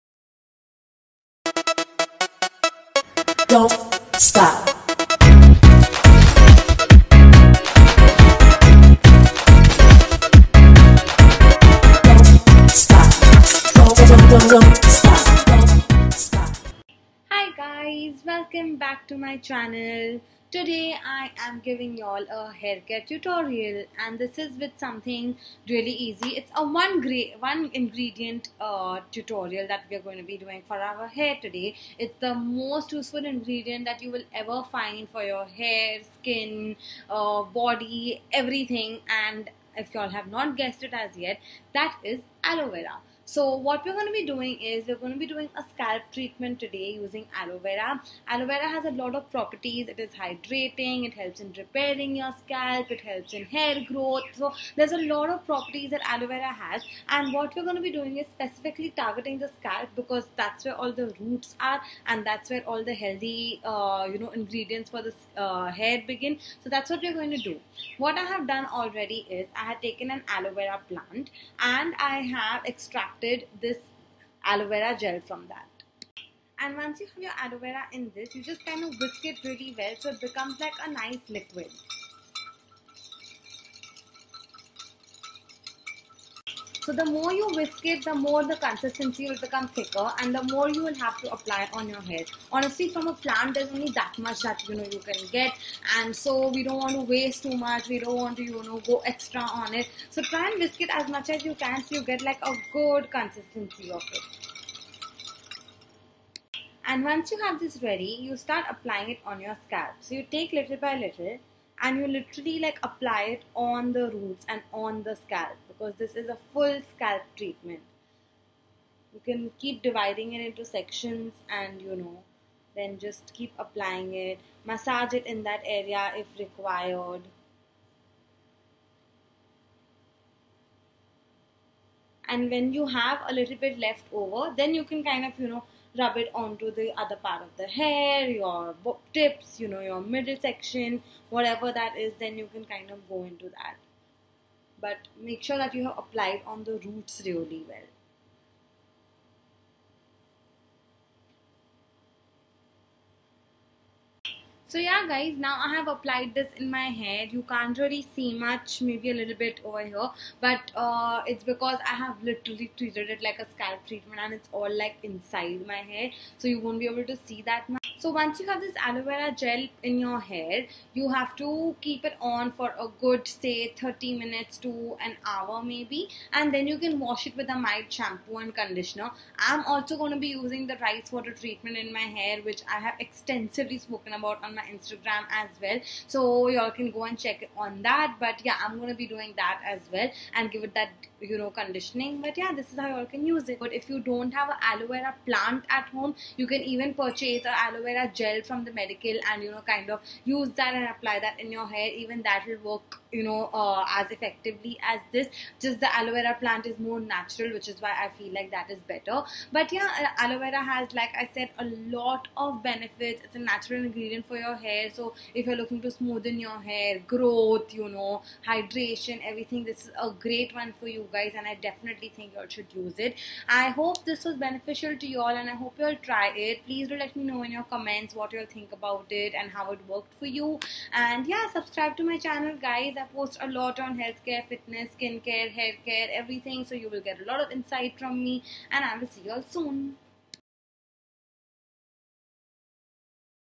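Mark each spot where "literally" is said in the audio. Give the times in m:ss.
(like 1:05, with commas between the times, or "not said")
1:52, 2:42.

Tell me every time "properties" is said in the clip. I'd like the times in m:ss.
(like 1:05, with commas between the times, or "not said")
0:49, 0:55.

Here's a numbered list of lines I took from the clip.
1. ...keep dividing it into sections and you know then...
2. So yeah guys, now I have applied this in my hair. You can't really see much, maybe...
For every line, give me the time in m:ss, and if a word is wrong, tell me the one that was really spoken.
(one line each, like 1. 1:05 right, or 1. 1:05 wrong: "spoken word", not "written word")
1. 1:59 right
2. 2:34 right.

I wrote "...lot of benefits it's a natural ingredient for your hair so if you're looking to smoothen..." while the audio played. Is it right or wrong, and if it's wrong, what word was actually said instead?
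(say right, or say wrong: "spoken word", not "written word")
right.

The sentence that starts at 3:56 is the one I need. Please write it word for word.
So you will get a lot of insight from me and I will see you all soon.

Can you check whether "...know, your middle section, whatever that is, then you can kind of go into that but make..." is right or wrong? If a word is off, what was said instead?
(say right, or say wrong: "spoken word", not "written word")
right.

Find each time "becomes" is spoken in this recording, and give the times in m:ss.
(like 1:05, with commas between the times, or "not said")
1:20, 1:29.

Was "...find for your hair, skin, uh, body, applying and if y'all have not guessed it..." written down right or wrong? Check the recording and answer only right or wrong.
wrong.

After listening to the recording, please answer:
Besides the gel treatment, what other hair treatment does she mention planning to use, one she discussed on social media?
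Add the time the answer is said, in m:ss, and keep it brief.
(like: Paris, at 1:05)
rice water treatment, at 3:00.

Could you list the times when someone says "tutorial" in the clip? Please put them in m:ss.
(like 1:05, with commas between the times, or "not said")
0:23, 0:29.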